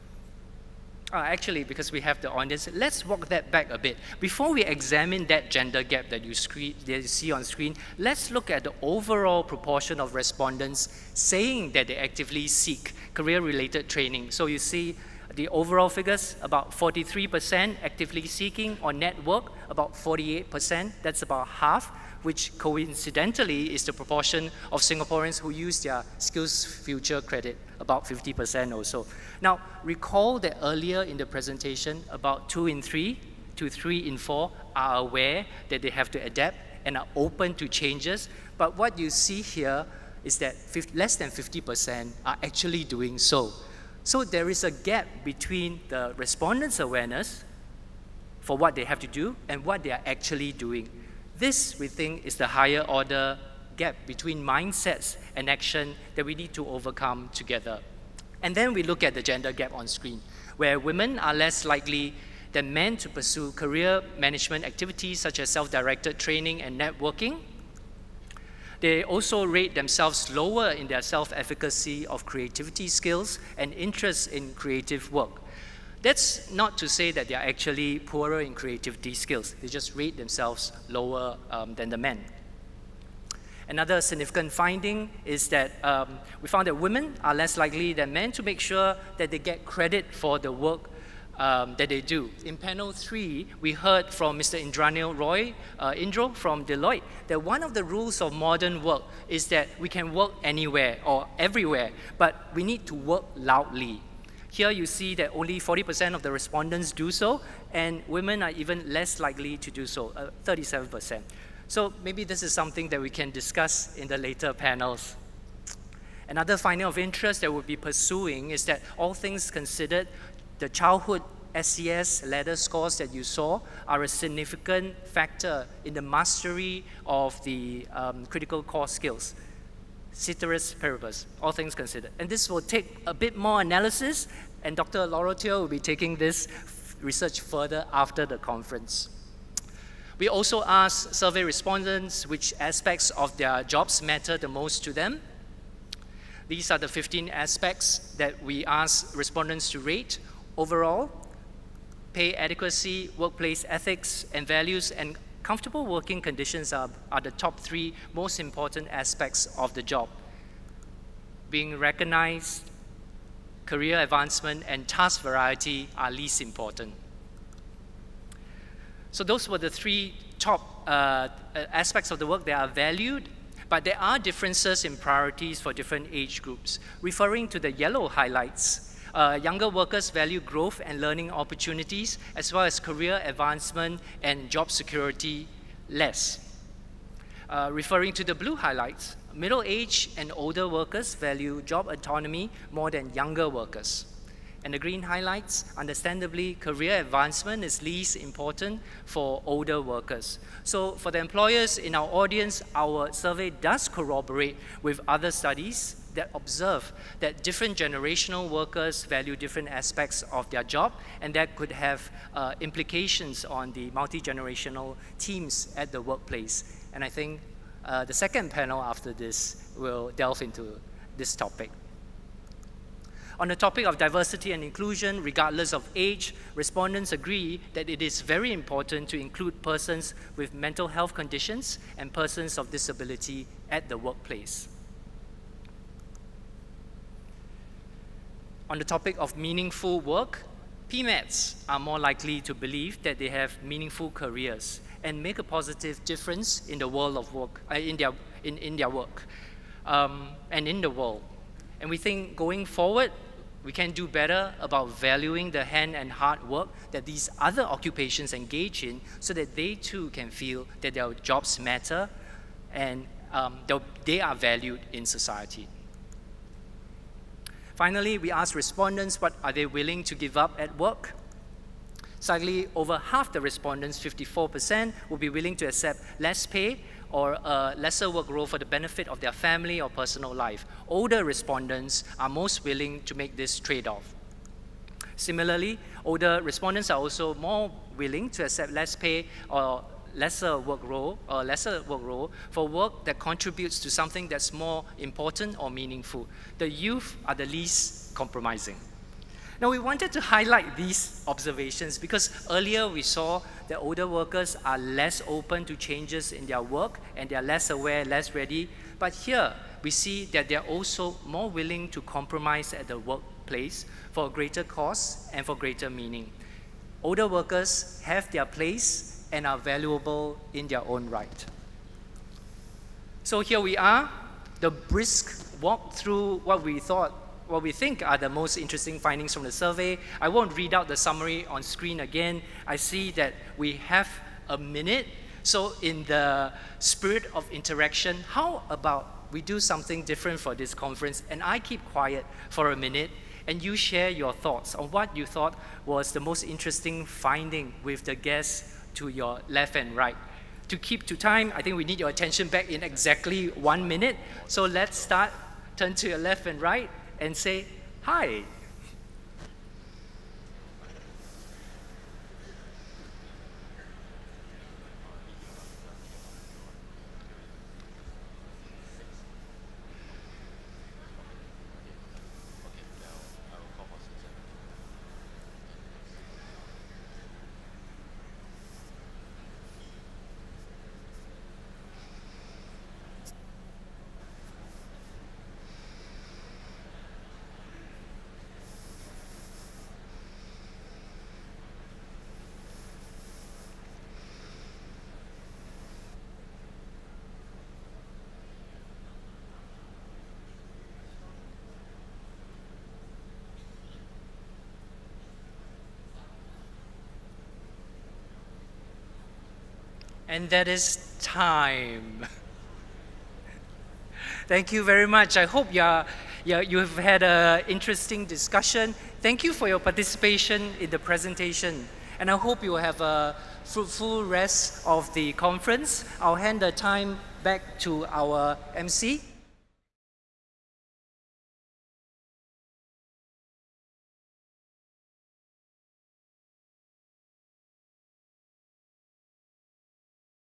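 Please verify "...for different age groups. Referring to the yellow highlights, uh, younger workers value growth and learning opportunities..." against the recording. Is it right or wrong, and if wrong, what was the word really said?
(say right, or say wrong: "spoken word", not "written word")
right.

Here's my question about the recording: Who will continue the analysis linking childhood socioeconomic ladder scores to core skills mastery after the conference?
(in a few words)
Dr. Laurentier Teo.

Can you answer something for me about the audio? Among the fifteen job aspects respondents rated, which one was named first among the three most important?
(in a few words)
Pay adequacy.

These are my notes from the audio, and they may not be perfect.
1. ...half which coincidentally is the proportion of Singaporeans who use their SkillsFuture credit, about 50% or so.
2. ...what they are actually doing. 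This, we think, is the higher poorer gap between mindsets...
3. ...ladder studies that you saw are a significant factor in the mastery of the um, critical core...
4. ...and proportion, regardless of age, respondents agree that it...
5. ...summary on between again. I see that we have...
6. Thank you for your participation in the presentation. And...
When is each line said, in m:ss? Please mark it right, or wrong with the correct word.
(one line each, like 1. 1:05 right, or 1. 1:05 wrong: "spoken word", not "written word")
1. 0:21 right
2. 0:49 wrong: "order", not "poorer"
3. 2:02 wrong: "scores", not "studies"
4. 3:44 wrong: "inclusion", not "proportion"
5. 5:30 wrong: "screen", not "between"
6. 6:59 right.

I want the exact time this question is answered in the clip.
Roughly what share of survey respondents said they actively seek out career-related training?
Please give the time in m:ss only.
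0:16.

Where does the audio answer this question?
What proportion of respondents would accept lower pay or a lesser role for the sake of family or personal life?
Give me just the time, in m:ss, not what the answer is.
4:33.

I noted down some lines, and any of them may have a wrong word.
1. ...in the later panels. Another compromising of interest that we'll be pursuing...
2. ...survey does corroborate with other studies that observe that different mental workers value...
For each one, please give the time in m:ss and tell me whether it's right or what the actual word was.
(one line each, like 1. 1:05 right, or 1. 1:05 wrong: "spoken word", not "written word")
1. 1:53 wrong: "finding", not "compromising"
2. 3:23 wrong: "generational", not "mental".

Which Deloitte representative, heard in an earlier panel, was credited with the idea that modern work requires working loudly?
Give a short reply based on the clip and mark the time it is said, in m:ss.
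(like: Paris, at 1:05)
Indranil Roy, at 1:34.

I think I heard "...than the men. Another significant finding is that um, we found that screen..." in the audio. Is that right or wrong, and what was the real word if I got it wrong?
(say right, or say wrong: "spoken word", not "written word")
wrong: "women", not "screen".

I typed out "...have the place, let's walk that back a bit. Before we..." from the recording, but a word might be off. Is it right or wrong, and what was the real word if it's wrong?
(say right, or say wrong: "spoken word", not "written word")
wrong: "audience", not "place".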